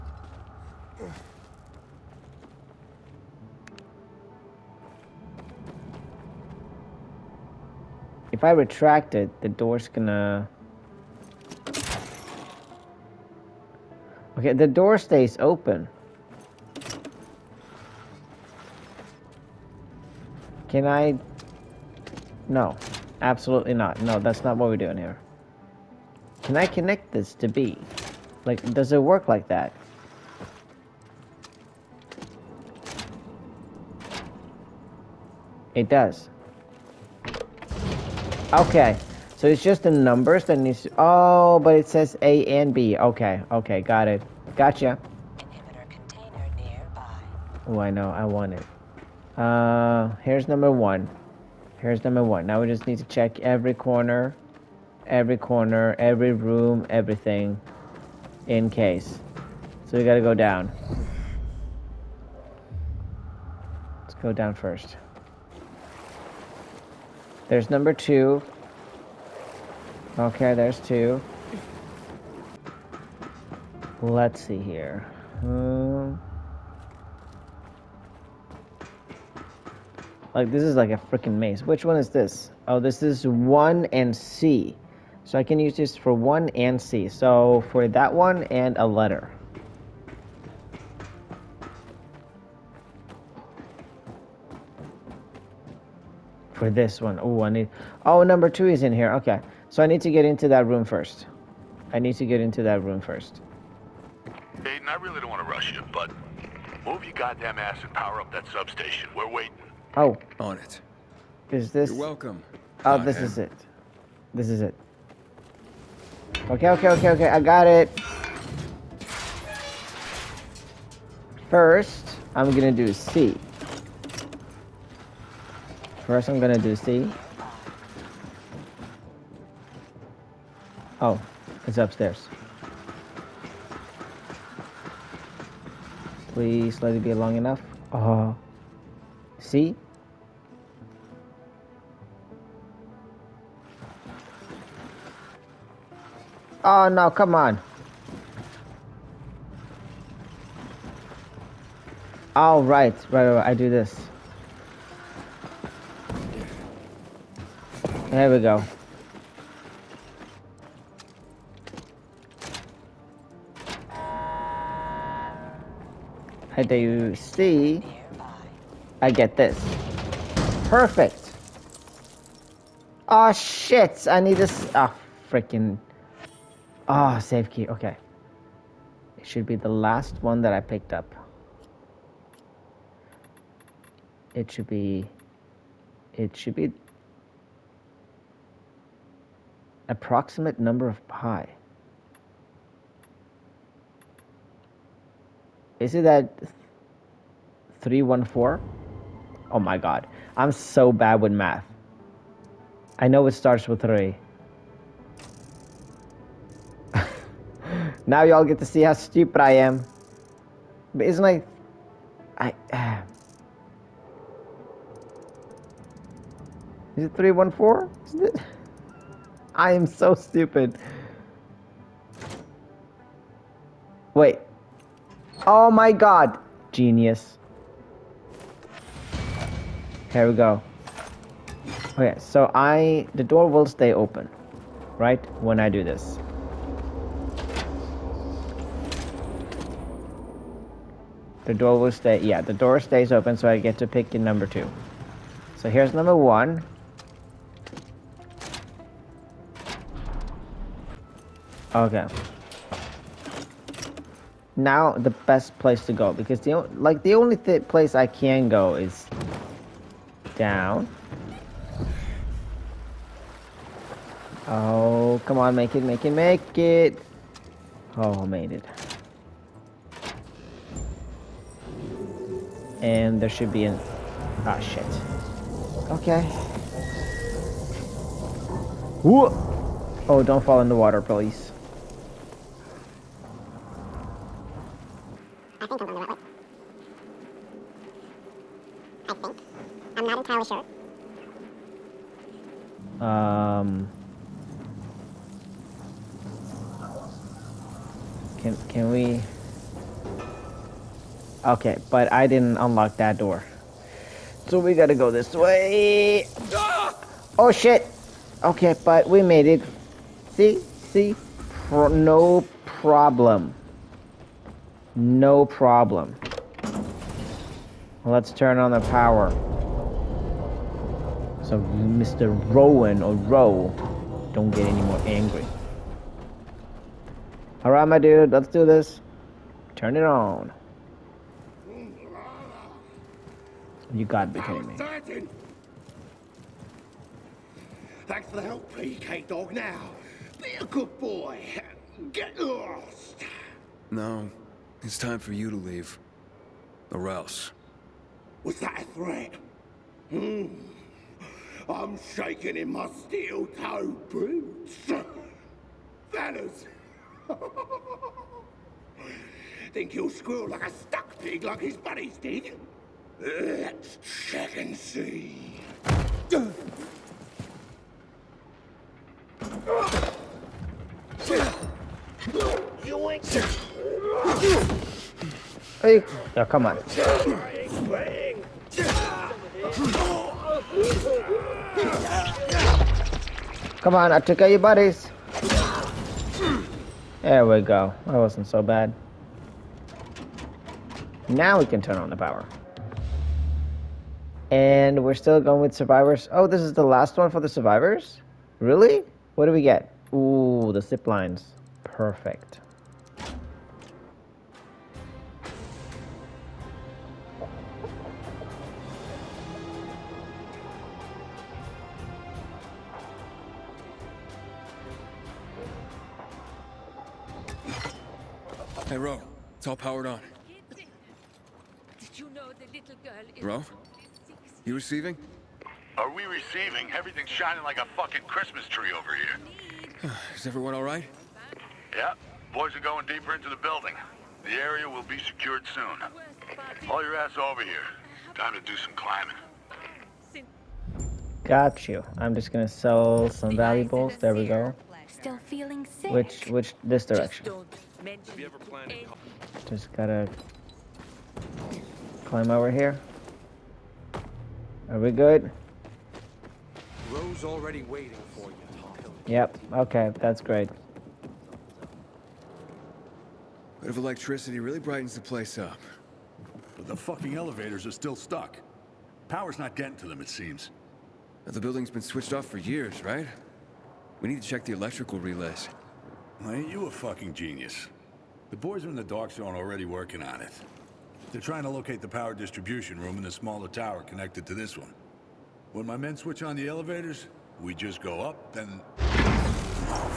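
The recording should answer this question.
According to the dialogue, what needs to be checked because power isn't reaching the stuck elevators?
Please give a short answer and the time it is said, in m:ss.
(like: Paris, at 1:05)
electrical relays, at 7:54.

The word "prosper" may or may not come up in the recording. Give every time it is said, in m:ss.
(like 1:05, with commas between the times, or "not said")
not said.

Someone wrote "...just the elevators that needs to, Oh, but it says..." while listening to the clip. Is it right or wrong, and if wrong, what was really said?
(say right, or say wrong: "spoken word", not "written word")
wrong: "numbers", not "elevators".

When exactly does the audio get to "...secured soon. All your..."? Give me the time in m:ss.
7:15.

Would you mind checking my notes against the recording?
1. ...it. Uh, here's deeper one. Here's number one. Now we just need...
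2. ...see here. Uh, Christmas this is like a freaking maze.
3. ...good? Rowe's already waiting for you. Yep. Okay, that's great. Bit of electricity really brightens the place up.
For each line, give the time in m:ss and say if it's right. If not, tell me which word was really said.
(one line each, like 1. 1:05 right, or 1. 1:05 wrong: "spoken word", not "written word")
1. 0:48 wrong: "number", not "deeper"
2. 1:14 wrong: "Like", not "Christmas"
3. 7:35 right.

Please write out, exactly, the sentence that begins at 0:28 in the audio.
Like, does it work like that?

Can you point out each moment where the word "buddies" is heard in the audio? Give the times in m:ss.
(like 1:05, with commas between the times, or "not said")
6:01, 6:24.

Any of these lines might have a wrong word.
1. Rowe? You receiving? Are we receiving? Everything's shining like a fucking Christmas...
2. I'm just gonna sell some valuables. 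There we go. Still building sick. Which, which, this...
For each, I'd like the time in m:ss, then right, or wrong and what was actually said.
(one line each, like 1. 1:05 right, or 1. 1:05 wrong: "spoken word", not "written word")
1. 7:03 right
2. 7:22 wrong: "feeling", not "building".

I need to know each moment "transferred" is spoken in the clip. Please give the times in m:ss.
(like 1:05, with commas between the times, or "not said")
not said.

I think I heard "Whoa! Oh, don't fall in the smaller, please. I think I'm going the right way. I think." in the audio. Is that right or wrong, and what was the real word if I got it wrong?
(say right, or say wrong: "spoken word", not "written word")
wrong: "water", not "smaller".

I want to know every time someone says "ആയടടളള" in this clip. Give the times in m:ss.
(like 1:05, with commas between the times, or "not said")
not said.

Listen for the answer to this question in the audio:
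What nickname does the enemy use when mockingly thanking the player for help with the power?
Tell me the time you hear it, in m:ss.
5:38.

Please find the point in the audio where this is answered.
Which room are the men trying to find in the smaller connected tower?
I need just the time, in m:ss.
8:02.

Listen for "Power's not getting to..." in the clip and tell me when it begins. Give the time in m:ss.
7:49.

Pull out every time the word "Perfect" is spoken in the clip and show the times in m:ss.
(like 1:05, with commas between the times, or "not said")
2:50, 6:41.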